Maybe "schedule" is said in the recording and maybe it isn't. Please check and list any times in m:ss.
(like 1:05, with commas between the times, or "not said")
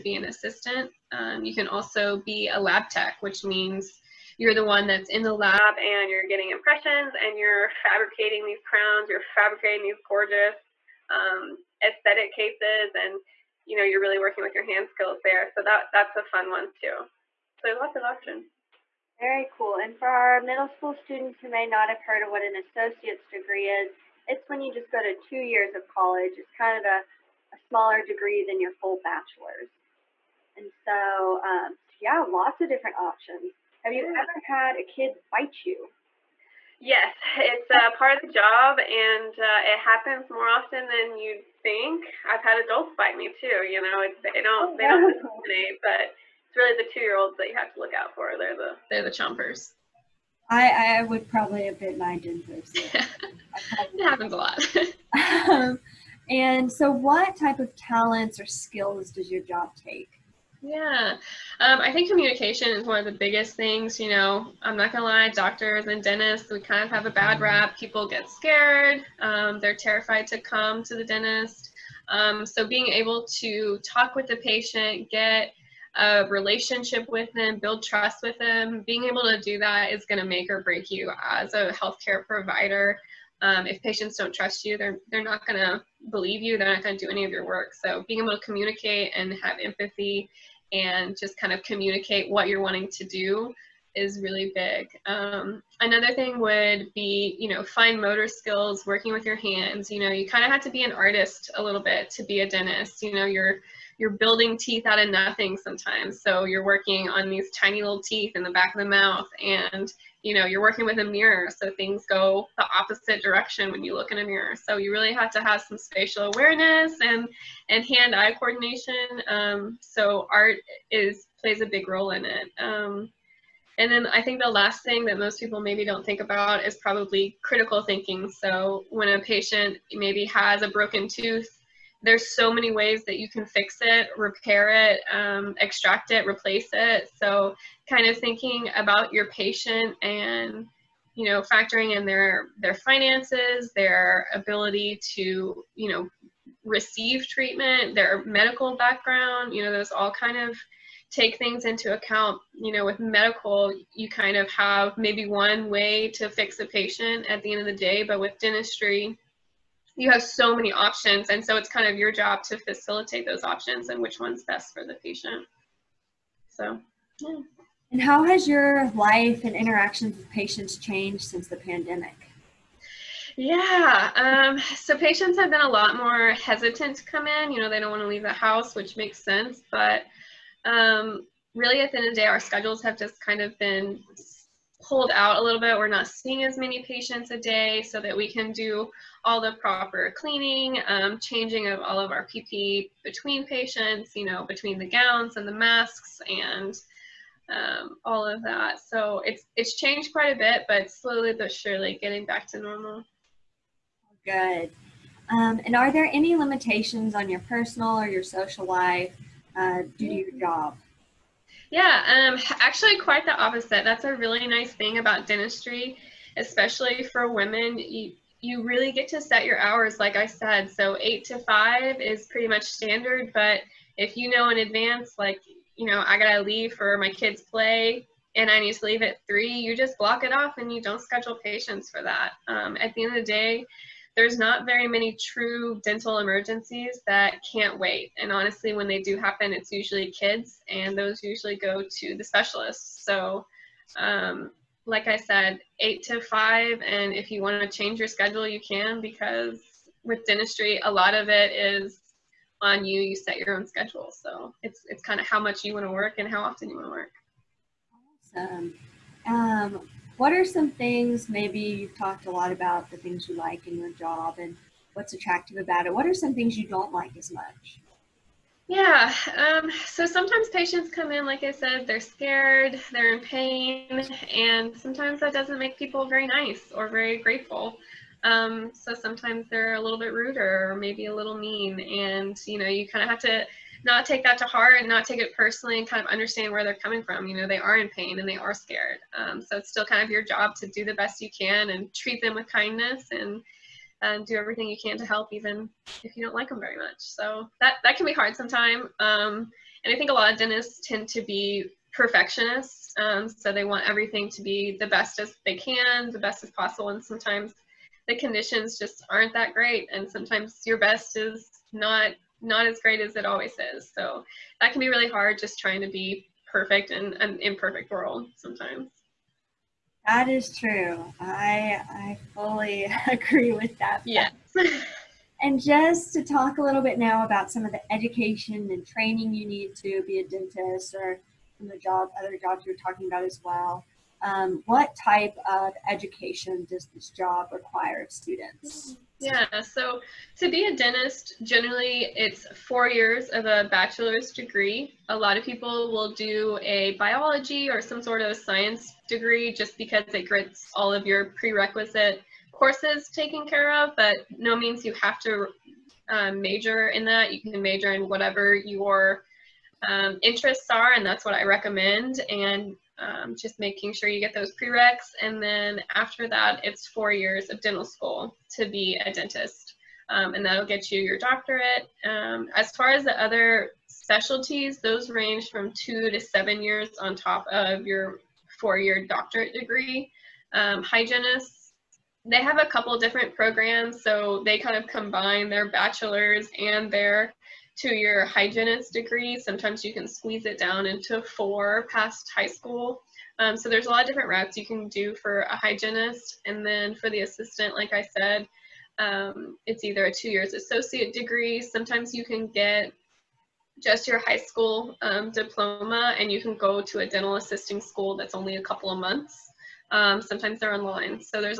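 3:02, 3:51, 4:08, 4:13.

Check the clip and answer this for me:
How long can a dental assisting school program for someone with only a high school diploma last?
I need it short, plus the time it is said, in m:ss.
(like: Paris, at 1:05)
a couple of months, at 6:48.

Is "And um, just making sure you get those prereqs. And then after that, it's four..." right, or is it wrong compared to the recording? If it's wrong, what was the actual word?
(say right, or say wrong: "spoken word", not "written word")
right.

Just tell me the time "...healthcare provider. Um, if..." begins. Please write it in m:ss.
1:21.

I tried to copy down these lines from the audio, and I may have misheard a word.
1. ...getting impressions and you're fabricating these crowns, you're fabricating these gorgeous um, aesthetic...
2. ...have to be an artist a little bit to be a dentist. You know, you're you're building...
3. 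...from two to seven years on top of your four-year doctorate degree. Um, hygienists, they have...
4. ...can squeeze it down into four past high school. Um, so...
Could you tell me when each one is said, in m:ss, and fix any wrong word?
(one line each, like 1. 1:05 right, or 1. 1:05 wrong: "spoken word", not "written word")
1. 0:06 right
2. 1:40 right
3. 6:15 right
4. 6:29 right.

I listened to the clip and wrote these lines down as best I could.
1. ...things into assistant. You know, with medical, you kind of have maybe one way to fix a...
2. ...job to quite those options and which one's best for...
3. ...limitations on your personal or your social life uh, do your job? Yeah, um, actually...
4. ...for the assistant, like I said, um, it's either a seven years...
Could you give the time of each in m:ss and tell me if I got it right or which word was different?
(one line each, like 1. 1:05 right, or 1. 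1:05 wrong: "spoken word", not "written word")
1. 2:31 wrong: "account", not "assistant"
2. 2:42 wrong: "facilitate", not "quite"
3. 3:26 right
4. 6:36 wrong: "two", not "seven".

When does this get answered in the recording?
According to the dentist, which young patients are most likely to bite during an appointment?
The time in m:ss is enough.
0:46.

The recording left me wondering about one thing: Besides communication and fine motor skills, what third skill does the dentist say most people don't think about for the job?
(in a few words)
critical thinking.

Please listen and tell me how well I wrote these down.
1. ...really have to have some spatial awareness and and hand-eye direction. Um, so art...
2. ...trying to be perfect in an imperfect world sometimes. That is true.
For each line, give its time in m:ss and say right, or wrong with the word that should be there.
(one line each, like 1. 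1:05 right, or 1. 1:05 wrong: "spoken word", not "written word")
1. 1:54 wrong: "coordination", not "direction"
2. 5:15 right.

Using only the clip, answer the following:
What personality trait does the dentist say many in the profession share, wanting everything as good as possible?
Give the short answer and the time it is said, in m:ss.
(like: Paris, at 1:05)
perfectionists, at 5:01.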